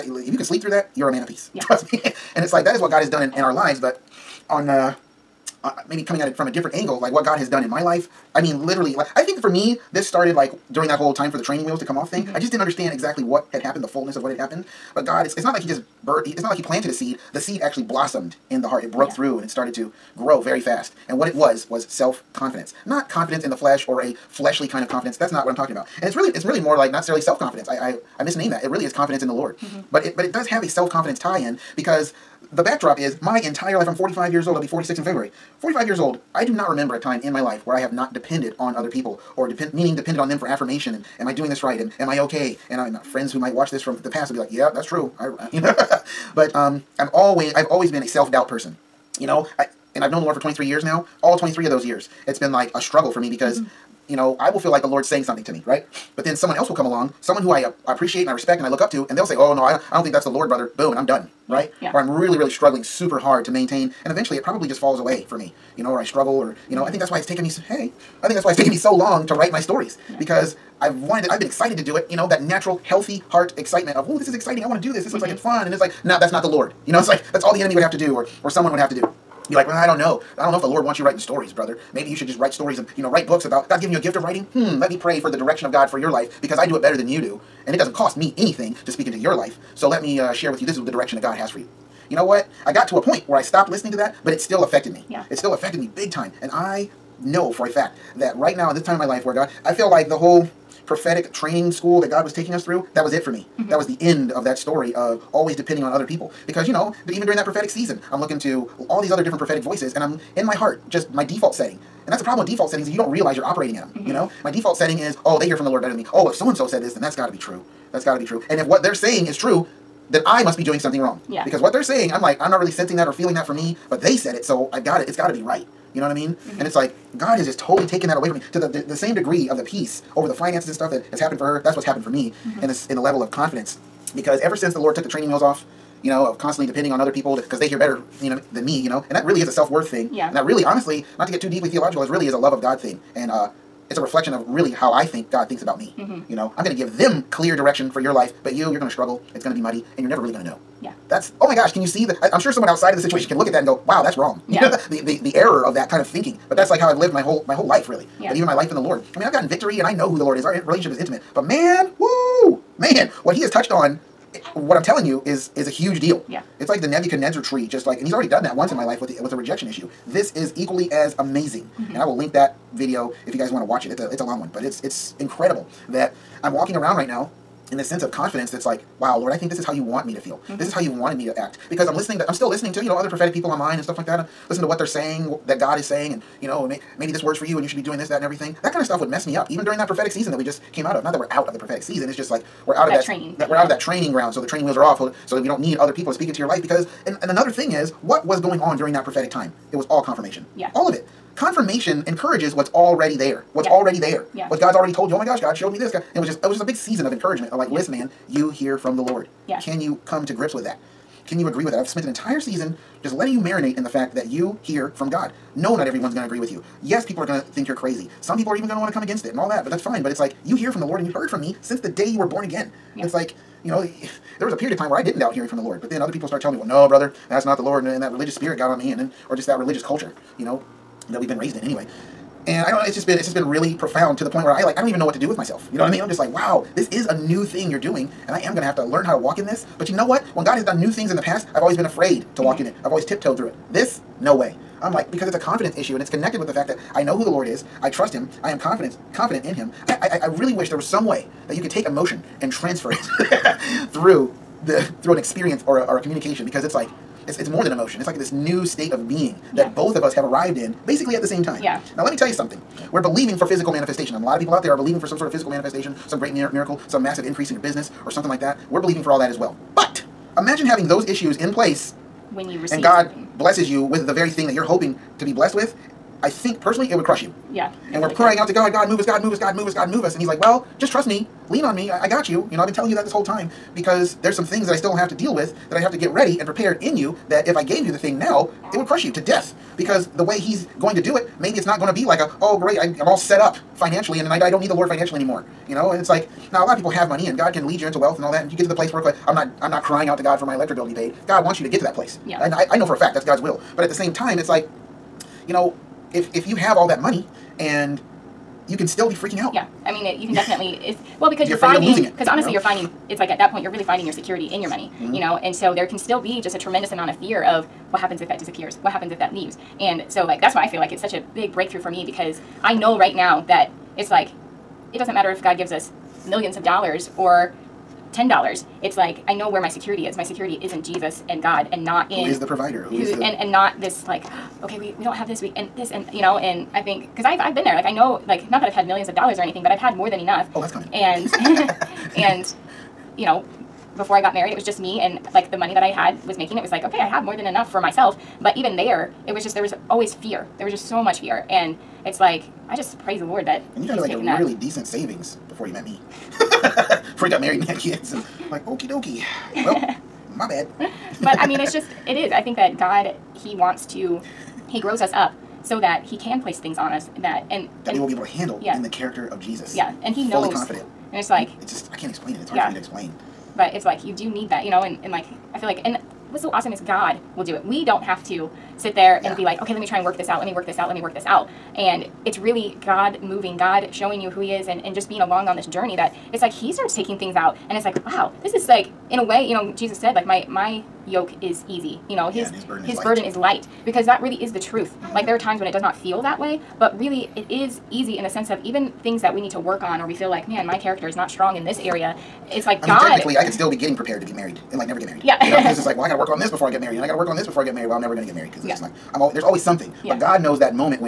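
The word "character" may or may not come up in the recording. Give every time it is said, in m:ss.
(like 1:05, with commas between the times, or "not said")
6:08, 6:40.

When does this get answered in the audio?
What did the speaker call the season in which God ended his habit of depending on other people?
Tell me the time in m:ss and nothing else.
1:40.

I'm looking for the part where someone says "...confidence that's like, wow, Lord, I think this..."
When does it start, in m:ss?
2:58.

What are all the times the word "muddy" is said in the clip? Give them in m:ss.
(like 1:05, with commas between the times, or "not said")
2:29.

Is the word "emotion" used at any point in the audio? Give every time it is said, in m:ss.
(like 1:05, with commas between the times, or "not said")
4:11, 4:17.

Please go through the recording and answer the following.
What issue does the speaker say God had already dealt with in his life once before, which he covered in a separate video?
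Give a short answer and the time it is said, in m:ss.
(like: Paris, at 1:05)
rejection, at 2:49.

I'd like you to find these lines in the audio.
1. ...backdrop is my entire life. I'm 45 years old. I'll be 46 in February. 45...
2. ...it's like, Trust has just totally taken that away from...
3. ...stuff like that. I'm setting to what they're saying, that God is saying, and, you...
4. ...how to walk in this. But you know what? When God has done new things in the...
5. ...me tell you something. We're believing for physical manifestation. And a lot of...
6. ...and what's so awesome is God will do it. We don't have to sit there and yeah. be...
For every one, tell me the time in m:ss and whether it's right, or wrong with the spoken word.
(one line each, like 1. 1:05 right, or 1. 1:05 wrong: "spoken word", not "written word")
1. 0:32 right
2. 2:06 wrong: "God", not "Trust"
3. 3:03 wrong: "listening", not "setting"
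4. 3:59 right
5. 4:22 right
6. 6:15 right.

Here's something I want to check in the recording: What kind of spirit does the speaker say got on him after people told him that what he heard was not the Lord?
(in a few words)
religious spirit.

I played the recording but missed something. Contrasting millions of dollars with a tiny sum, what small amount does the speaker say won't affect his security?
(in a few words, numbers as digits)
$10.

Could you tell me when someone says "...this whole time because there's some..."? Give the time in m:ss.
4:43.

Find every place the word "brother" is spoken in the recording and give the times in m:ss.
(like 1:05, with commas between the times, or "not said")
1:00, 1:21, 3:46.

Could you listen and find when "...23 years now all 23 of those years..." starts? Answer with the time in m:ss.
0:50.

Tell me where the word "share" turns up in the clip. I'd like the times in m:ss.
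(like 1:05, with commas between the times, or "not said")
1:30.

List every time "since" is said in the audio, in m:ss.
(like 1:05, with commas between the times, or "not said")
2:14, 3:41.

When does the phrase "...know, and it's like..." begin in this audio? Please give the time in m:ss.
4:55.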